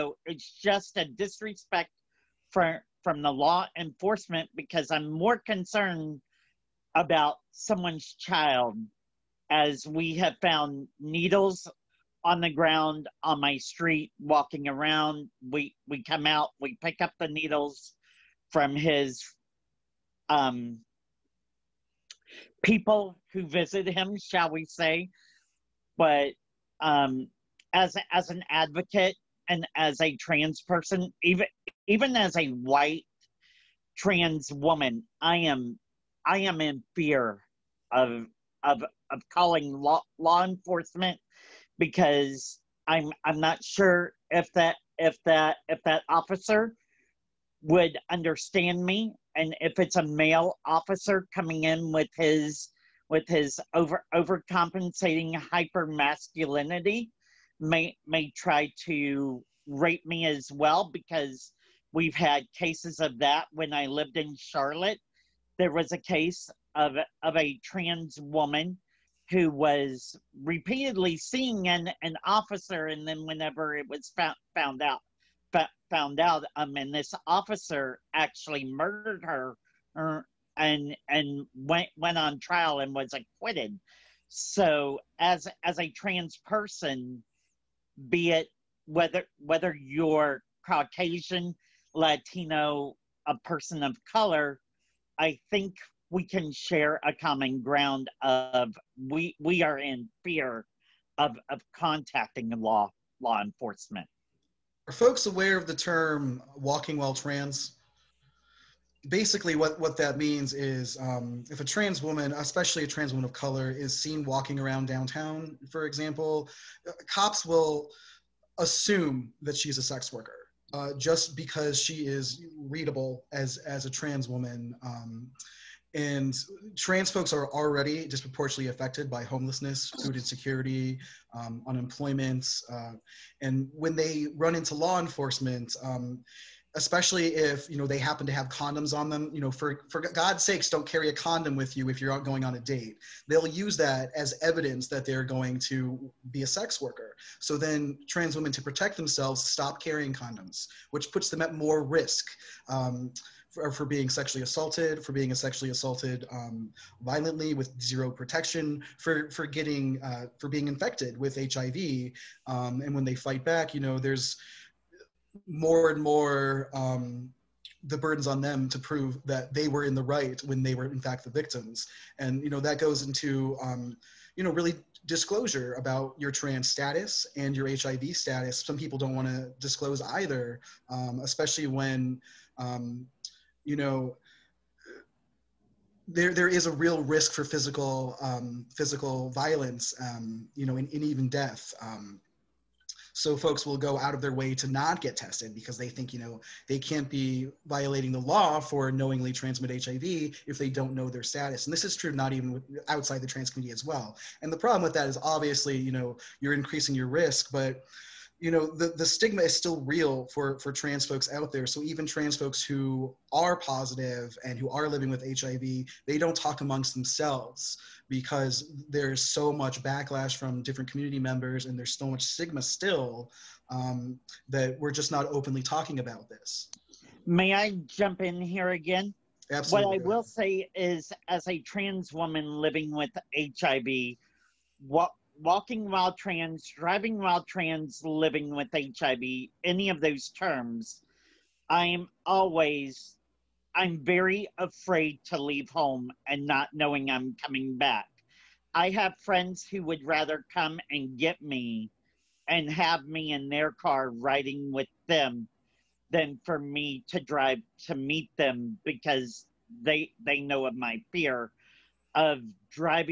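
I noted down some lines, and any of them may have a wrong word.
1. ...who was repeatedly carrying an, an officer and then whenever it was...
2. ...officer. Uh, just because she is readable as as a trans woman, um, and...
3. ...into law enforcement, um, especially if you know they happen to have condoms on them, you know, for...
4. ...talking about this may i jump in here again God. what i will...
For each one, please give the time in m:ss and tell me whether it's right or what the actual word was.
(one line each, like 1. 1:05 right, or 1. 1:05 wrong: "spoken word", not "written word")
1. 1:09 wrong: "seeing", not "carrying"
2. 2:00 wrong: "worker", not "officer"
3. 2:14 right
4. 3:45 wrong: "Absolutely", not "God".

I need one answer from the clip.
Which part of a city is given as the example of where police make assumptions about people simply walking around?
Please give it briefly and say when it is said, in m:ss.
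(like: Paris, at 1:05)
Downtown, at 1:54.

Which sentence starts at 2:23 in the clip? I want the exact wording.
They'll use that as evidence that they're going to be a sex worker.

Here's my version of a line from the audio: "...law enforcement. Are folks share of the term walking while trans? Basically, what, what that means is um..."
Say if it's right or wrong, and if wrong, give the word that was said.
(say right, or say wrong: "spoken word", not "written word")
wrong: "aware", not "share".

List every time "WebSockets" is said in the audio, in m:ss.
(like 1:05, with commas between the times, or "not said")
not said.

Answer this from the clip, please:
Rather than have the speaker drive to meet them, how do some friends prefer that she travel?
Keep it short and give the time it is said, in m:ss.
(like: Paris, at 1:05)
In their car, at 4:13.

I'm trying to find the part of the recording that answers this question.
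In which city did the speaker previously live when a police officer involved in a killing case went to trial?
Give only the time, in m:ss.
1:04.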